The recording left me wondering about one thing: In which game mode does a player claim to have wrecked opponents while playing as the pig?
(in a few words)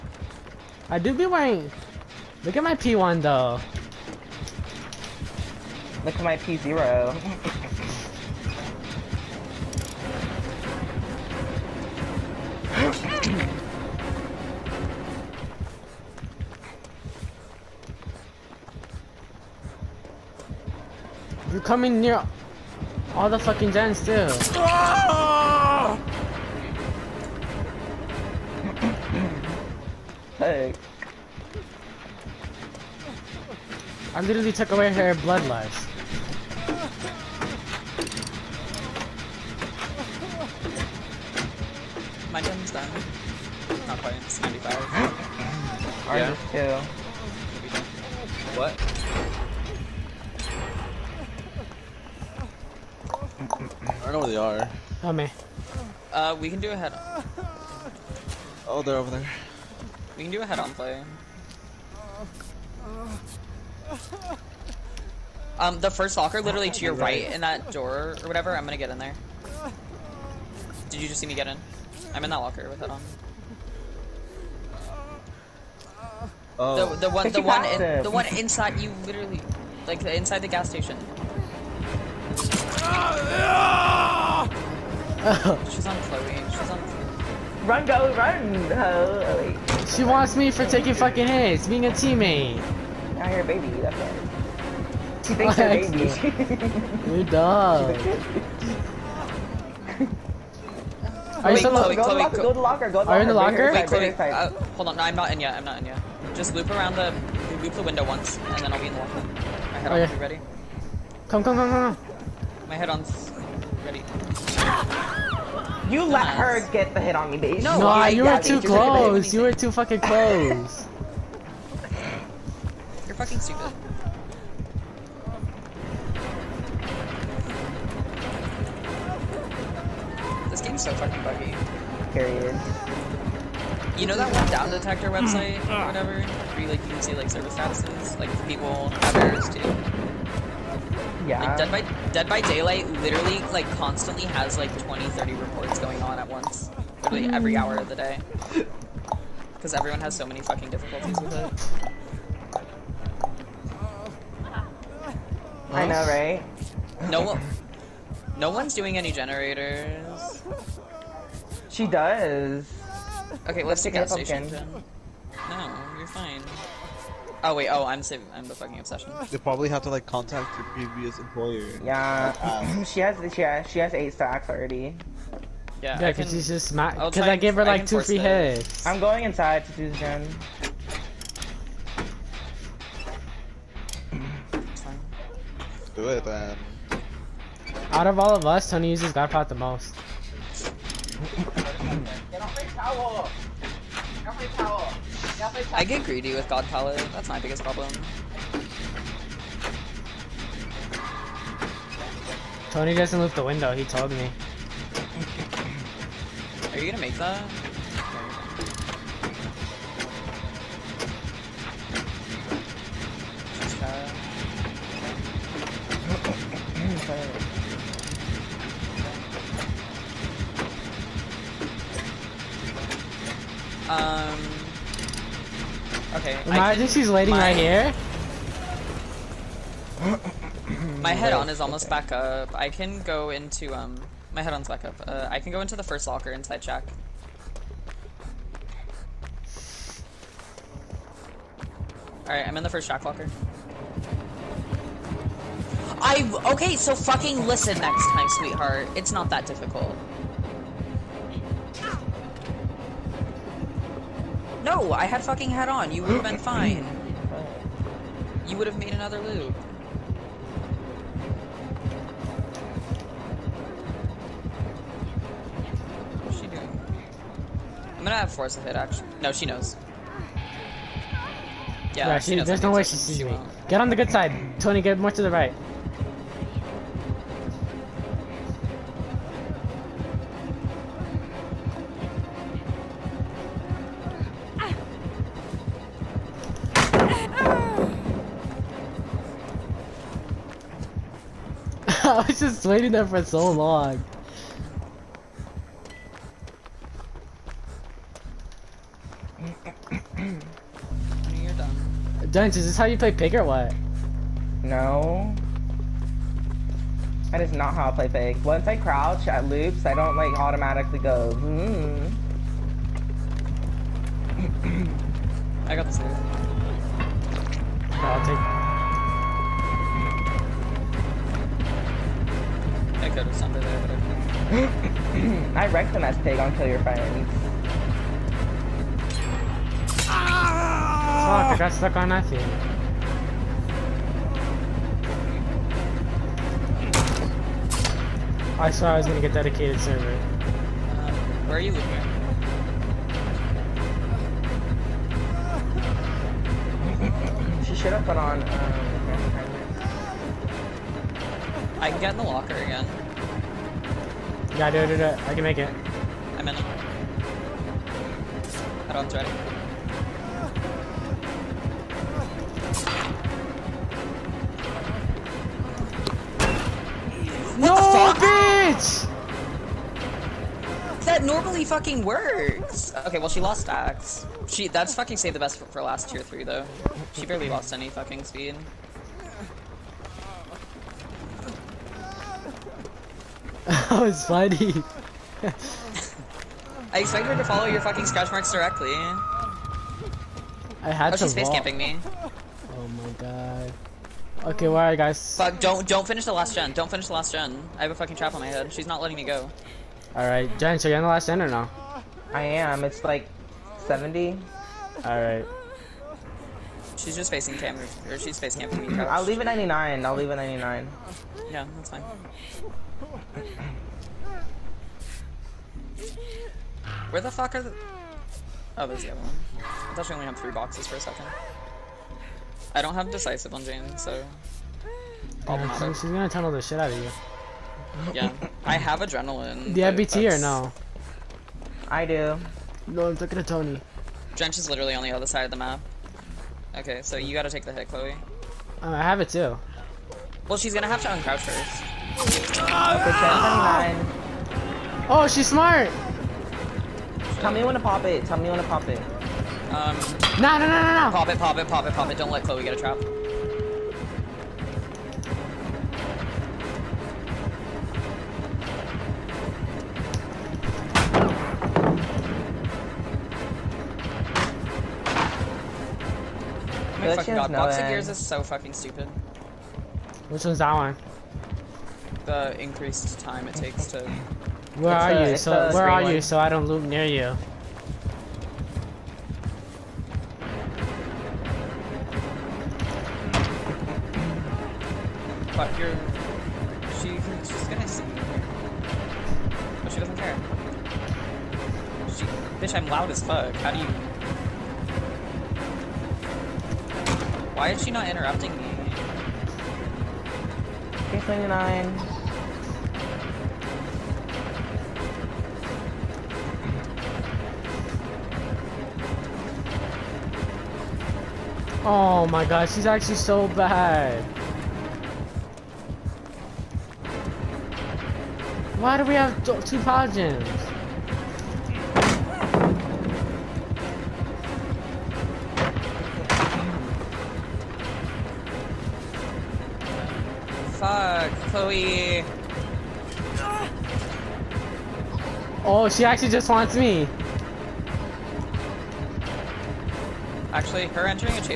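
Kill Your Friends.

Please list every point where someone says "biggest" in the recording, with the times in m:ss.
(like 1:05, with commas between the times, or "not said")
3:17.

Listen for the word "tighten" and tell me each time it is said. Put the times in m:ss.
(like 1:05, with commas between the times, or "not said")
not said.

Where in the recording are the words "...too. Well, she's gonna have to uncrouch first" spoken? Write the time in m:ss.
7:19.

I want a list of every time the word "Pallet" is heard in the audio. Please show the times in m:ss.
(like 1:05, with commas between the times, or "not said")
3:16.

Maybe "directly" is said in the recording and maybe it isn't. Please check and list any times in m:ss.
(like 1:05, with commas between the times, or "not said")
6:28.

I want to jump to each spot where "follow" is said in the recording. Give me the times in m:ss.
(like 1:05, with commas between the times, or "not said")
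6:27.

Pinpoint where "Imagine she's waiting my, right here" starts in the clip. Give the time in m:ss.
3:46.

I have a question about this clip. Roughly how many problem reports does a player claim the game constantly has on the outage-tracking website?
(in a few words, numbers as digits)
20, 30.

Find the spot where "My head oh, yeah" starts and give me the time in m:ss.
1:49.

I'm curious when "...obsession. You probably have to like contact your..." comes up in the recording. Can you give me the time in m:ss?
2:48.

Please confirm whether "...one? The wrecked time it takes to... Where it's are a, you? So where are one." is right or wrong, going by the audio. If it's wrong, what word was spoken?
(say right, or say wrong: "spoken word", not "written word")
wrong: "increased", not "wrecked".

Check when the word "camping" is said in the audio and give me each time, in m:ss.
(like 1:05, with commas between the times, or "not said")
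6:31, 6:48.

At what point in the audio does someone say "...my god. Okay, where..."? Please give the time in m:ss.
6:33.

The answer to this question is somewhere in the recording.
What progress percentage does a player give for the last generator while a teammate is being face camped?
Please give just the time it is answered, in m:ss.
6:42.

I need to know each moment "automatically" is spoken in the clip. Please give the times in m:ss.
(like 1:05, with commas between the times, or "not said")
5:10.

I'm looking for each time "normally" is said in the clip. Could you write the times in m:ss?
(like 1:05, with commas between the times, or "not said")
6:11.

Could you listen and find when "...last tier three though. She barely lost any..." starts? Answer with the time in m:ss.
6:15.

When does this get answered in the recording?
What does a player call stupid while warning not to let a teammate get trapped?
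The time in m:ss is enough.
7:47.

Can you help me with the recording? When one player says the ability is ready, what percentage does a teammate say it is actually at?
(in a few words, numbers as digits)
95.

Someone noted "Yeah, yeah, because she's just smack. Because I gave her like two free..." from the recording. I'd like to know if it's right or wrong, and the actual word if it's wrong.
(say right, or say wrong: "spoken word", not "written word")
right.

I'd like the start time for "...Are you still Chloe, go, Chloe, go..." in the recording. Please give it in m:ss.
1:41.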